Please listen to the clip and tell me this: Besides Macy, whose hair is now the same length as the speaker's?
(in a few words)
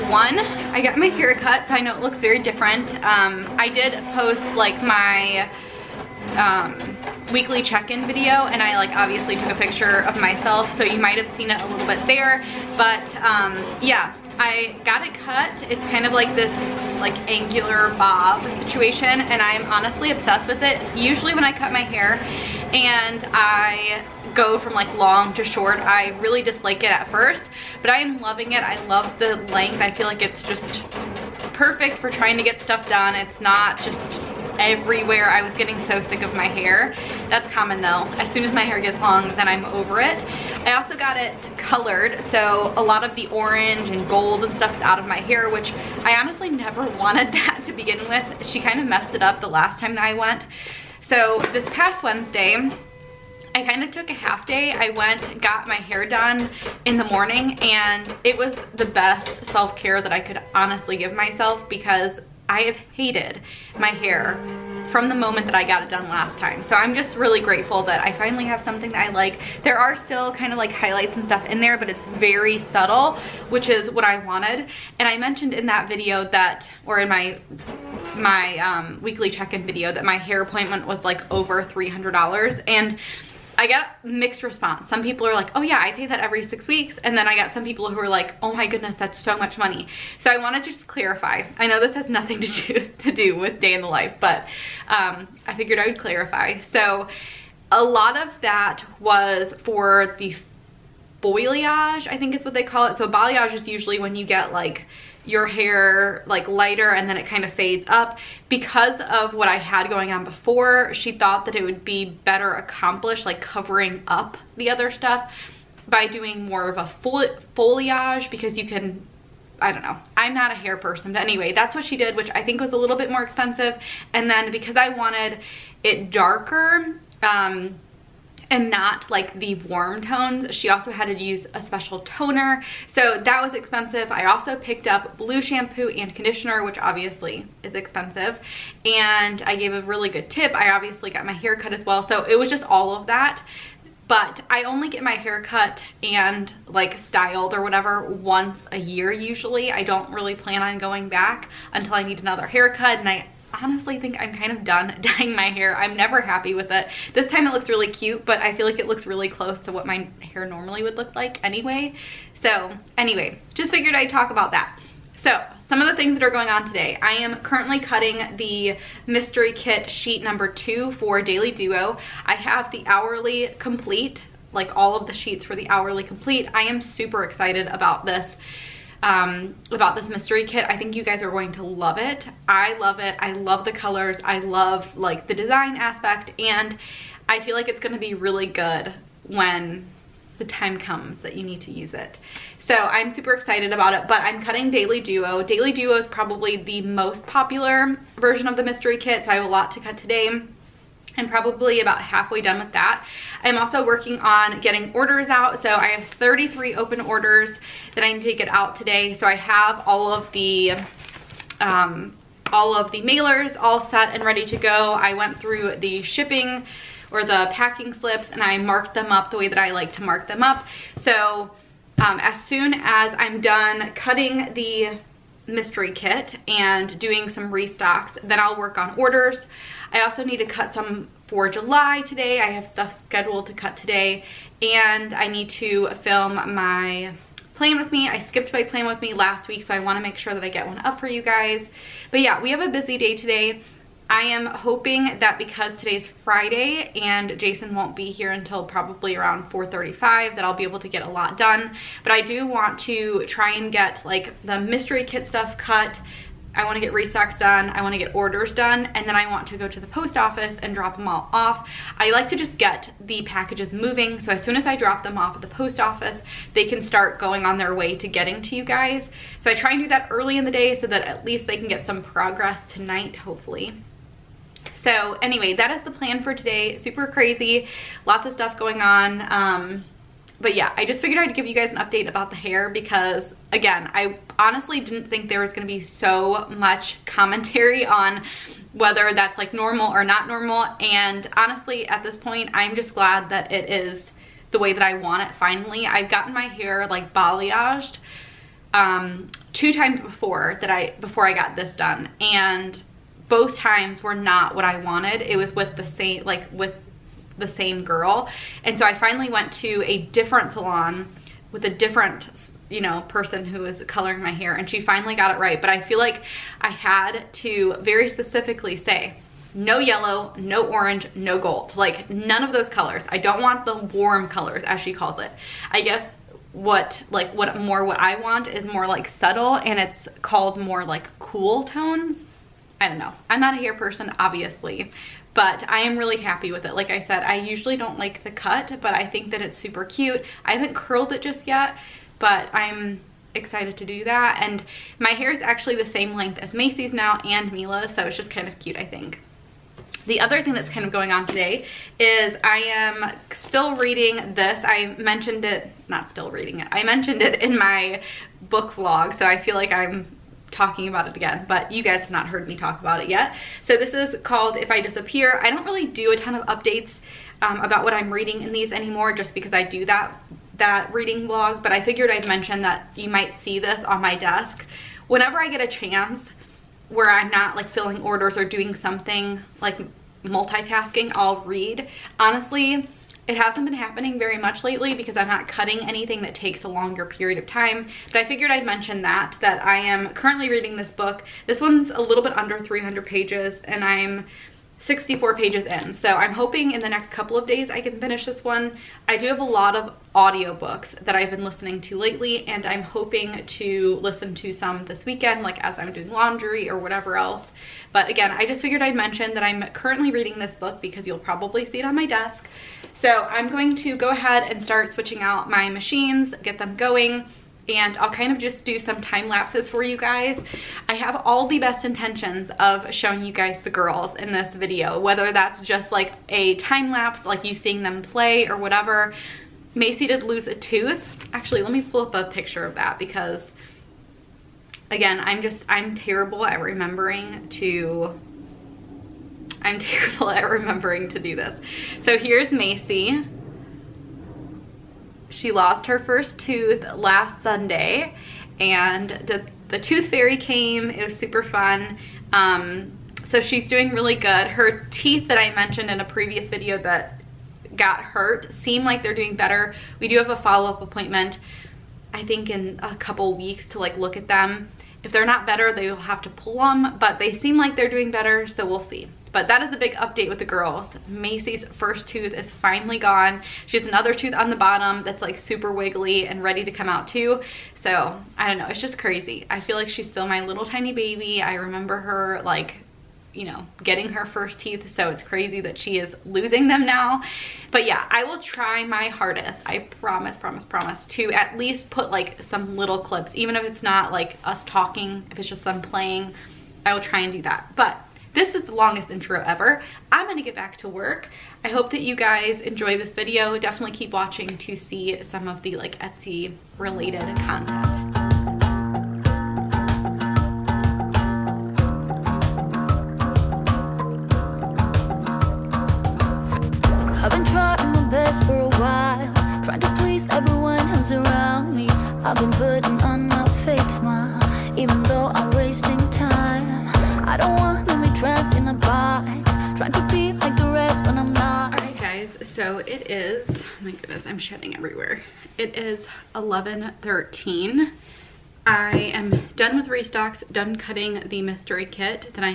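Mila.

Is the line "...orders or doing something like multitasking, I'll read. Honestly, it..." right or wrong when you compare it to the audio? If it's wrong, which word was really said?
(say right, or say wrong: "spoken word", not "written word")
right.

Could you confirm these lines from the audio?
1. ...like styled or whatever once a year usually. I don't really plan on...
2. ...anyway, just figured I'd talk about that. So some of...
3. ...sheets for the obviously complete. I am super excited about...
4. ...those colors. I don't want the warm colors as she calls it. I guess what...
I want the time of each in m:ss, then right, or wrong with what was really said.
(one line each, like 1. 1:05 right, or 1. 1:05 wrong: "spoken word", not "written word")
1. 2:26 right
2. 2:42 right
3. 2:55 wrong: "hourly", not "obviously"
4. 5:22 right.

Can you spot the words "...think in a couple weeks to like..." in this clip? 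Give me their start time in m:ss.
7:42.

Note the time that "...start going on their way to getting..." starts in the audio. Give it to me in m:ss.
4:26.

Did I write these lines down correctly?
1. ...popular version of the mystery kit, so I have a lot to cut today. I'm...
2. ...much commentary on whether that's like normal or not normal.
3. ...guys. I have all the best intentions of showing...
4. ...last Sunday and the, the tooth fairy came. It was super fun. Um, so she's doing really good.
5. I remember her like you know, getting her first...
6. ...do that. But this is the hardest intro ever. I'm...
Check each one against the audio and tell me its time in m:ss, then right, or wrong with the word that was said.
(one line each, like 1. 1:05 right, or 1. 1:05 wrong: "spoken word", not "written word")
1. 3:17 right
2. 4:46 right
3. 6:59 right
4. 7:26 right
5. 8:01 right
6. 8:17 wrong: "longest", not "hardest".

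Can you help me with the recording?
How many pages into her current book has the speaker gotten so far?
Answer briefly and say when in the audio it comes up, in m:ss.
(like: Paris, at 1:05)
64, at 6:34.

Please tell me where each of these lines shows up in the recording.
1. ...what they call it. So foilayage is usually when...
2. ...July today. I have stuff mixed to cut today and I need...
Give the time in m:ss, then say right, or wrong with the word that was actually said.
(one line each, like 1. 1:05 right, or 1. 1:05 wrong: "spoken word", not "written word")
1. 1:42 wrong: "balayage", not "foilayage"
2. 3:51 wrong: "scheduled", not "mixed".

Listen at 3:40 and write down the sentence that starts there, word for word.
So um, as soon as I'm done cutting the mystery kit and doing some restocks.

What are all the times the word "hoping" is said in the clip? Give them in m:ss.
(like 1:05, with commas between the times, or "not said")
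4:04, 6:36, 6:42.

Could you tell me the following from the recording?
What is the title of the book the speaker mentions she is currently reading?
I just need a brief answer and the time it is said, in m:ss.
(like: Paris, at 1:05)
If I Disappear, at 6:04.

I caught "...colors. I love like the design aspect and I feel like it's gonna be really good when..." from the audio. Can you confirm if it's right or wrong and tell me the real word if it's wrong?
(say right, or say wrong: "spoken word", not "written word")
right.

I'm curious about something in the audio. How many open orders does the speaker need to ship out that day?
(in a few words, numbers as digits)
33.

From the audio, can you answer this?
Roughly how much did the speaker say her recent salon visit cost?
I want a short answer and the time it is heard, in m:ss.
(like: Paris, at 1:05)
over $300, at 1:21.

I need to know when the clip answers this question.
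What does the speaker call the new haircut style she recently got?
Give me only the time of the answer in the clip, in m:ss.
0:17.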